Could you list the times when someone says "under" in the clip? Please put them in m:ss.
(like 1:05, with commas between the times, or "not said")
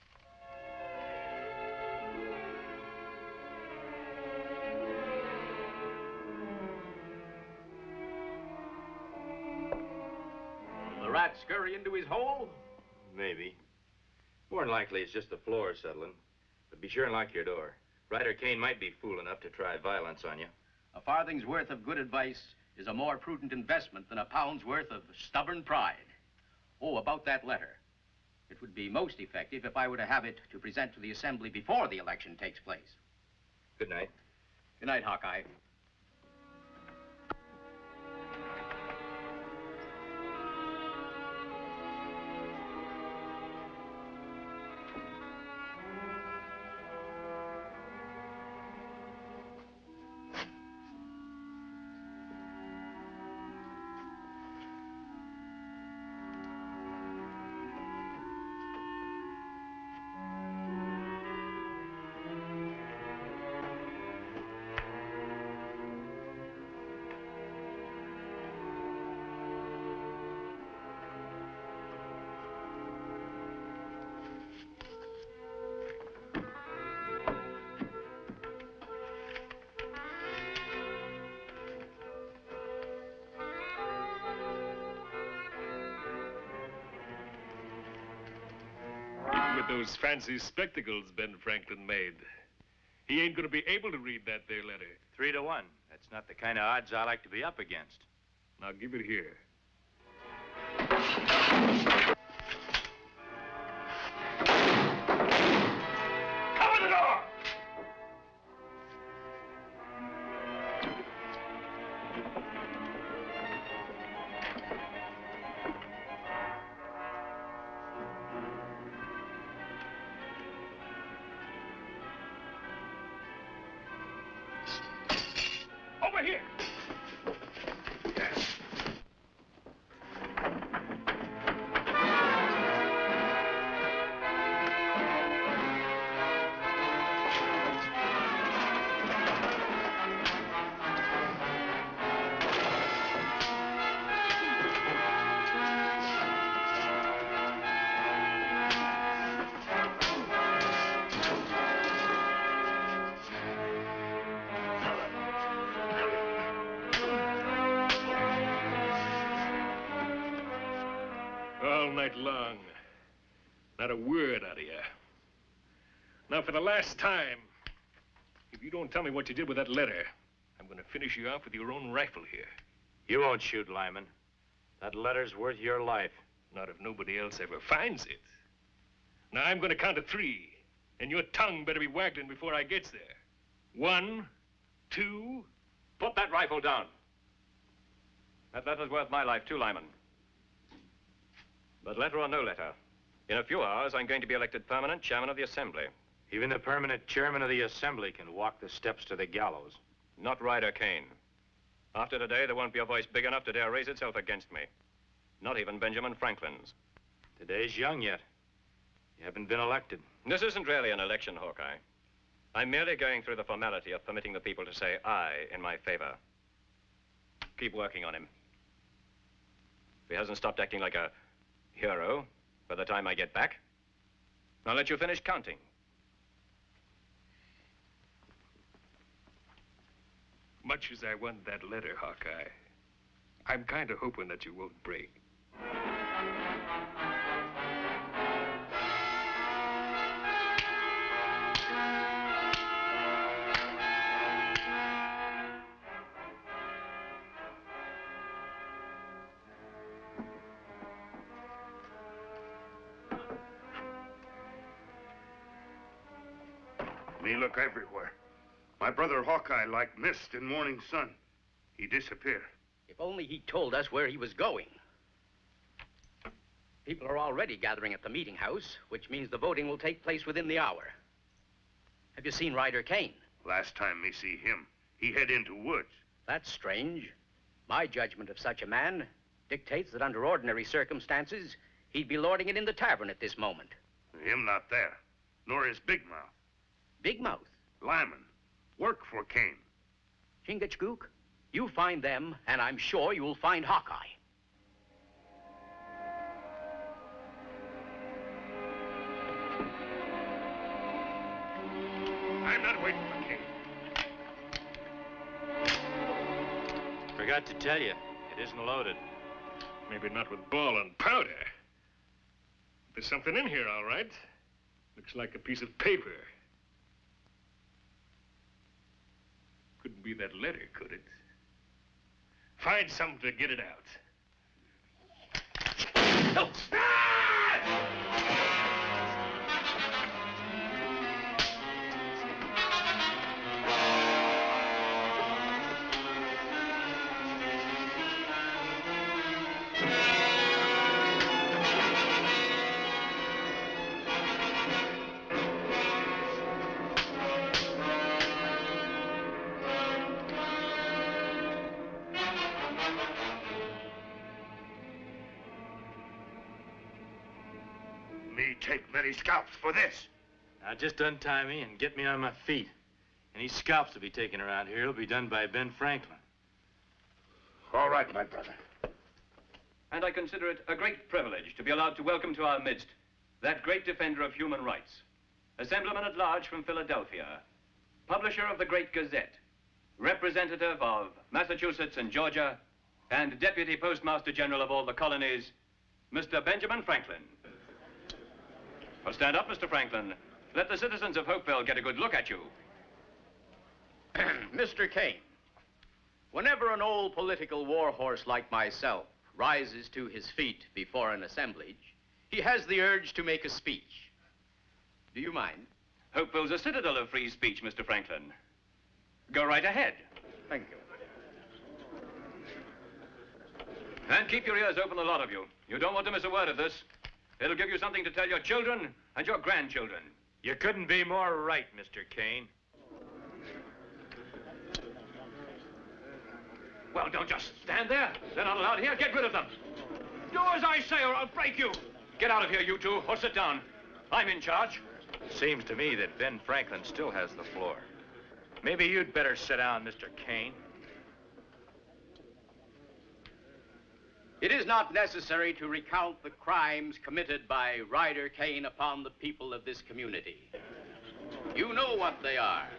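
4:40.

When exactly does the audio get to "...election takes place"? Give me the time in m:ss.
0:31.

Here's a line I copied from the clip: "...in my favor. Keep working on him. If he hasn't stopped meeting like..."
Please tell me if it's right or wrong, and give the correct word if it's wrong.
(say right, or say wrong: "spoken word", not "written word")
wrong: "acting", not "meeting".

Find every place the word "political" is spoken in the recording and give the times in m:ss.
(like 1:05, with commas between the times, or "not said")
6:37.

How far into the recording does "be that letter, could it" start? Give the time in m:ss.
5:20.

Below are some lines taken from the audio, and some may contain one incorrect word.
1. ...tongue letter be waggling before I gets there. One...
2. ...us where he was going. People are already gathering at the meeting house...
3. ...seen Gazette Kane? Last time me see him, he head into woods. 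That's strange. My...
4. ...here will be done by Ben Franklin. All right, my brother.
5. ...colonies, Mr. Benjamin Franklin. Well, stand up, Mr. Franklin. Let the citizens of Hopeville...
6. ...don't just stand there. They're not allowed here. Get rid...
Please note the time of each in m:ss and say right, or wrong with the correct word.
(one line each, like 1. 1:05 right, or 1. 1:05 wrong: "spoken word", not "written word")
1. 3:01 wrong: "better", not "letter"
2. 4:23 right
3. 4:32 wrong: "Ryder", not "Gazette"
4. 6:04 right
5. 6:24 right
6. 7:07 right.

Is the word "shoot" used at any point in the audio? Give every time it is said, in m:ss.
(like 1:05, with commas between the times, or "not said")
2:53.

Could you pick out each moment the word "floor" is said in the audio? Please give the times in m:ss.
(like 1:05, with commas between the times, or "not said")
0:15, 7:17.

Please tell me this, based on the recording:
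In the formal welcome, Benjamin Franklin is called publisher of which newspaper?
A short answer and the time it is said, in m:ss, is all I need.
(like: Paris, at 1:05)
The Great Gazette, at 6:18.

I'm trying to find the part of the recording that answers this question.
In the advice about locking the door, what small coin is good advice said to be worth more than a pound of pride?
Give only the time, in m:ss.
0:20.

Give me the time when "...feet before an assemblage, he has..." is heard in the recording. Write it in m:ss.
6:40.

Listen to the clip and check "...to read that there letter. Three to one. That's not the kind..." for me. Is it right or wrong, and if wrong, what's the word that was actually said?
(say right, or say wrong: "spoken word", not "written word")
right.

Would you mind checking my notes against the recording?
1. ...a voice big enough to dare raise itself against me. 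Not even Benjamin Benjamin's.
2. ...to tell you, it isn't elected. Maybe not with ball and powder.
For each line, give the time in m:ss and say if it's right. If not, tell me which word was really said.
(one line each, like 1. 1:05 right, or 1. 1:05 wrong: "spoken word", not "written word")
1. 3:22 wrong: "Franklin", not "Benjamin"
2. 5:07 wrong: "loaded", not "elected".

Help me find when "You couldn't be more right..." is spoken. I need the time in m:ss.
7:00.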